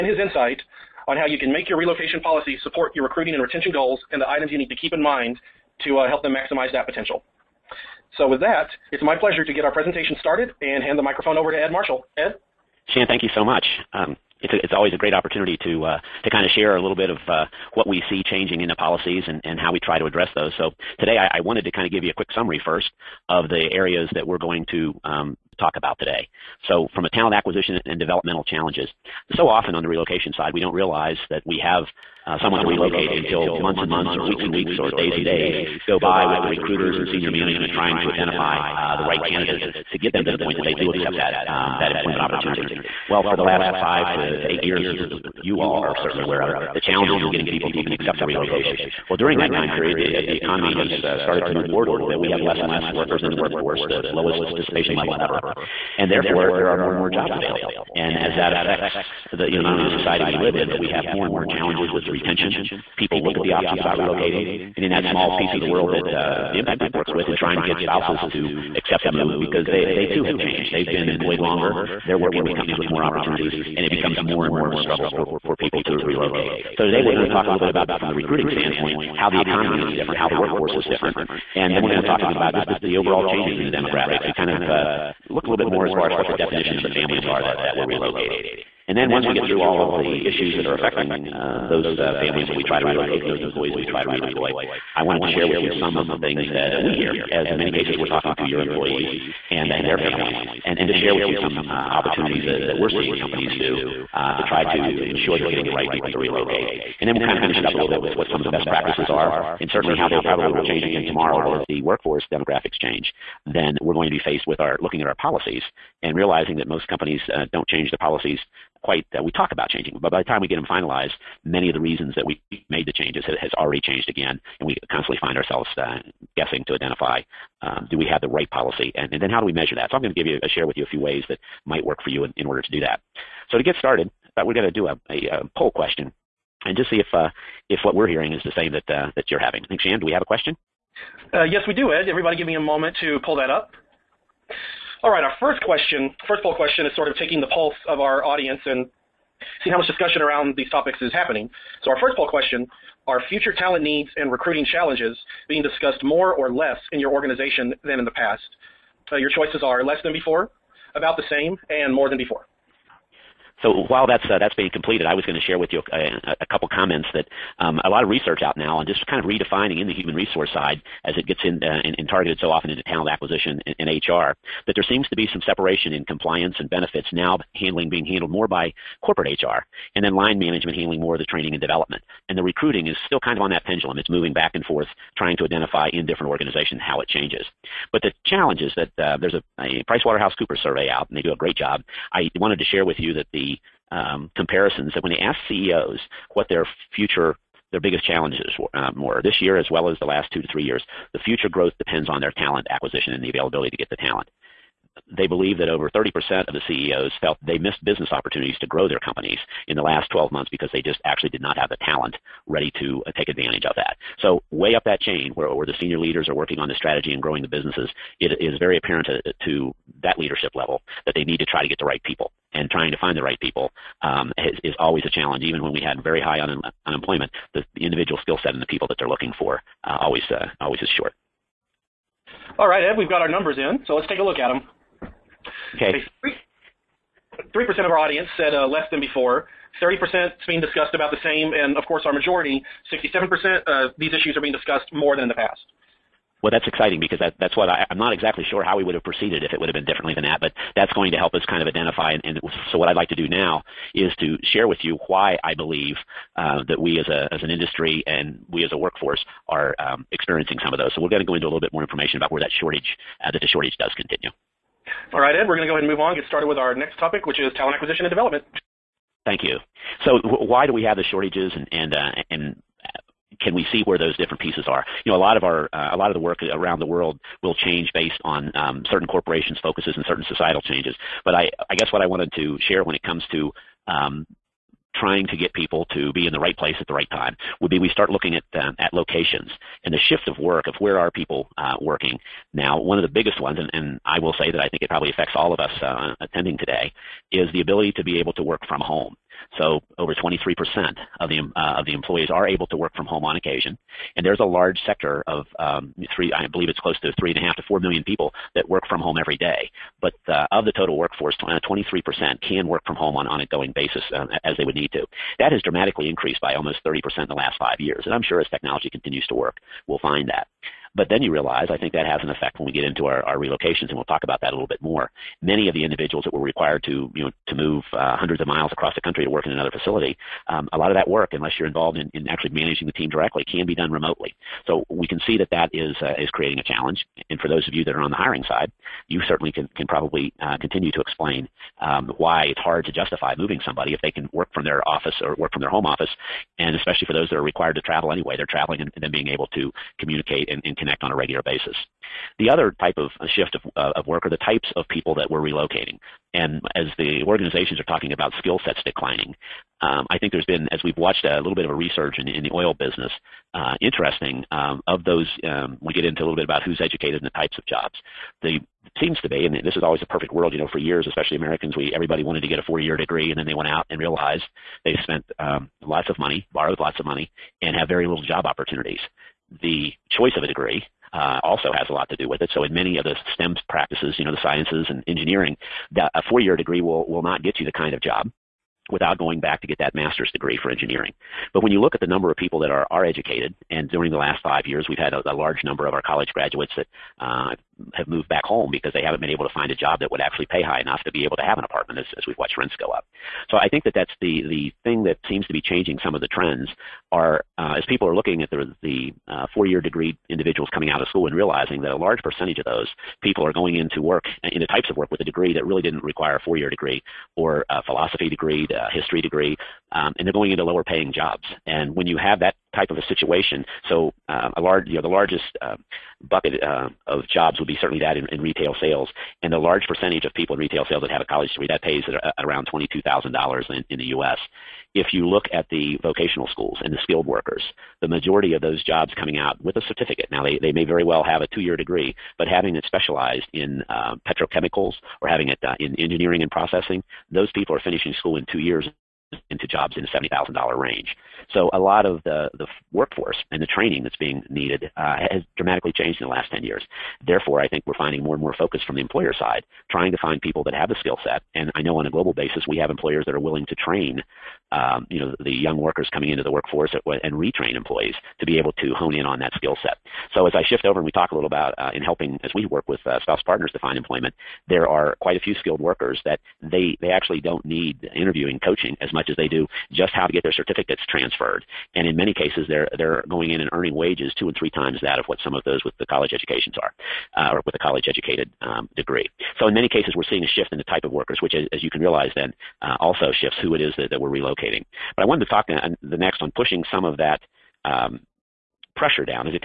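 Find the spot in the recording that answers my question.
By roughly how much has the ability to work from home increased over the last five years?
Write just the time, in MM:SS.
05:16.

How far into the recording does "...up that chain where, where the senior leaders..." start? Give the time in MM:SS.
03:34.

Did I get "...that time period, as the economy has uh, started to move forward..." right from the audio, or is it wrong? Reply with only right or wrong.
right.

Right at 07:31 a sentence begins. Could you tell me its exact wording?
So a lot of the, the, workforce and the training that's being needed uh, has dramatically changed in the last 10 years.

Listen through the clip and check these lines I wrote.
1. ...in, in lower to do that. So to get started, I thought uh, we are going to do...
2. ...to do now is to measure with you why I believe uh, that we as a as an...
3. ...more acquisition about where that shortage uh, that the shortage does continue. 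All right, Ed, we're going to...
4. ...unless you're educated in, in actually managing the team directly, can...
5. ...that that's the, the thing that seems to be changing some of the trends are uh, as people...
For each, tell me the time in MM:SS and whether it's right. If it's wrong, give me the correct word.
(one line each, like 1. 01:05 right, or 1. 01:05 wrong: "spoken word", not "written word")
1. 02:12 wrong: "order", not "lower"
2. 04:13 wrong: "share", not "measure"
3. 04:21 wrong: "information", not "acquisition"
4. 05:31 wrong: "involved", not "educated"
5. 06:43 right.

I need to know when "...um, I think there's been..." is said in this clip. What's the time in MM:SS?
05:59.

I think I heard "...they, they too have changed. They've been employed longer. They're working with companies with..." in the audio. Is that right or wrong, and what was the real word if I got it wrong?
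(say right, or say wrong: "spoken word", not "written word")
right.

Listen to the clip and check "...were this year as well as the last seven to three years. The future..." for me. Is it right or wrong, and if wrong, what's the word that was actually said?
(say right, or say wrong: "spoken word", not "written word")
wrong: "two", not "seven".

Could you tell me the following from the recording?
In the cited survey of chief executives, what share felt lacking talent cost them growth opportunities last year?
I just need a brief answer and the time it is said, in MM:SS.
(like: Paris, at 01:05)
over 30%, at 03:25.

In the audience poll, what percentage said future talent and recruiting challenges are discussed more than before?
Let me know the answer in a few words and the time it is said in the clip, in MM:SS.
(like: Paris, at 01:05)
67%, at 04:02.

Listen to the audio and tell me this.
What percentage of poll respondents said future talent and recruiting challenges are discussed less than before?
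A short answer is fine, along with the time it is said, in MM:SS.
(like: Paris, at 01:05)
3%, at 03:57.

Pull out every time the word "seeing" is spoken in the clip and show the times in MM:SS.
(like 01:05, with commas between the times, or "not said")
01:42, 02:29, 08:10.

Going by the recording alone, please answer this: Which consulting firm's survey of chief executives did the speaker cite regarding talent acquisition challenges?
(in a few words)
PricewaterhouseCoopers.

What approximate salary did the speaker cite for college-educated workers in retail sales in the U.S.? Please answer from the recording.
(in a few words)
$22,000.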